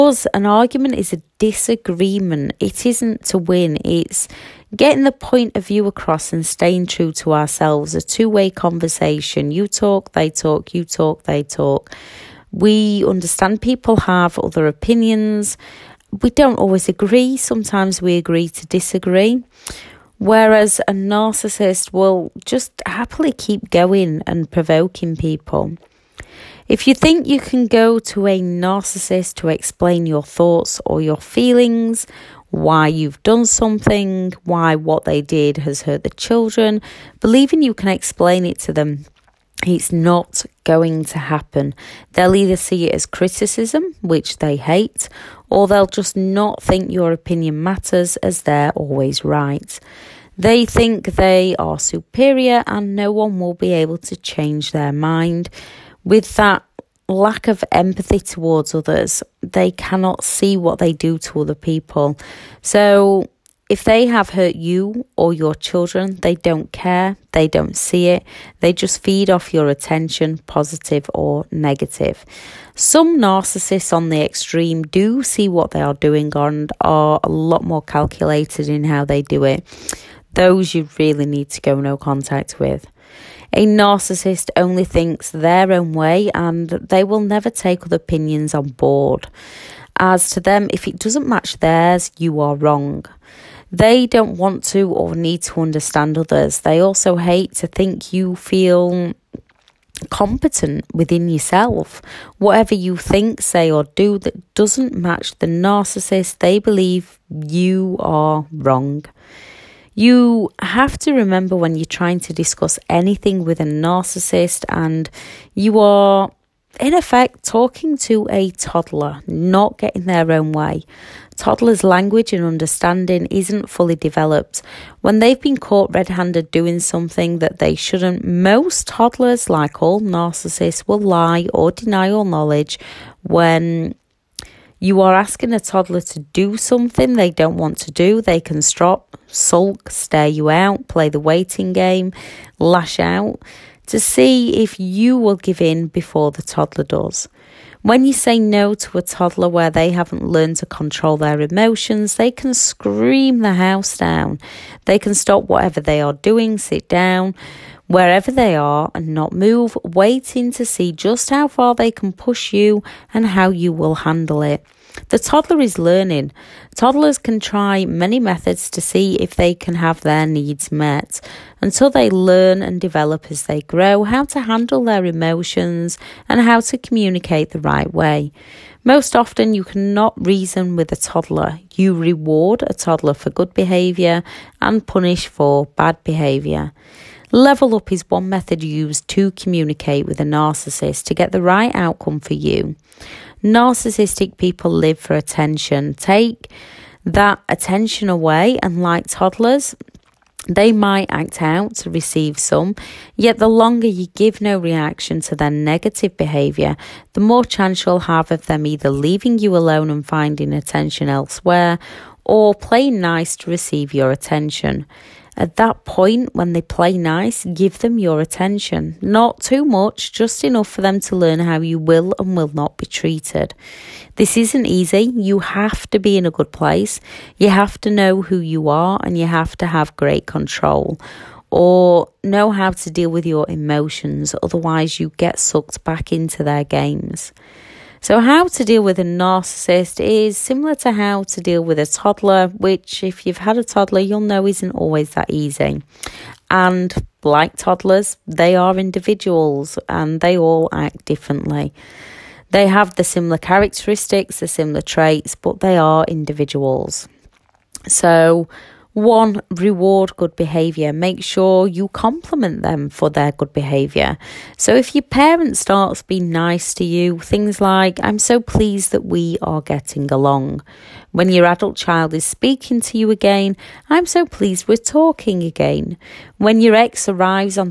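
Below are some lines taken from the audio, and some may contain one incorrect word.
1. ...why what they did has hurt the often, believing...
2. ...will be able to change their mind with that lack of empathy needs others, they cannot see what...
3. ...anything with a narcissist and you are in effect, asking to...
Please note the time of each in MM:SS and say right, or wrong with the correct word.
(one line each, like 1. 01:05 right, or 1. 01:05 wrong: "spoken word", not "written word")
1. 00:34 wrong: "children", not "often"
2. 00:53 wrong: "towards", not "needs"
3. 01:52 wrong: "talking", not "asking".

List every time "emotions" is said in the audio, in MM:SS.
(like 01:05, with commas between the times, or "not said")
02:31, 02:55, 03:53.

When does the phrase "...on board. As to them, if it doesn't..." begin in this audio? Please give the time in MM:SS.
01:28.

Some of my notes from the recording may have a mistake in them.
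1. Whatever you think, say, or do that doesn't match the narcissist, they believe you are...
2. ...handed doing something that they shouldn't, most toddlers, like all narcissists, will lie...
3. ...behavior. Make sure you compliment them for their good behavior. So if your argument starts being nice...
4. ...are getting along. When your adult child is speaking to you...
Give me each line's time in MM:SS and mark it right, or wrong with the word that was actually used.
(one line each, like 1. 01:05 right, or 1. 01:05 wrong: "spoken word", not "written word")
1. 01:42 right
2. 02:06 right
3. 04:20 wrong: "parent", not "argument"
4. 04:29 right.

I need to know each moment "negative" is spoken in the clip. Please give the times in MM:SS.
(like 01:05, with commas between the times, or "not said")
01:11, 03:25.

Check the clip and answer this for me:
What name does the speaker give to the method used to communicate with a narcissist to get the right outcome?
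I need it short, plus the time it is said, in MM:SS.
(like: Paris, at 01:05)
Level up, at 03:07.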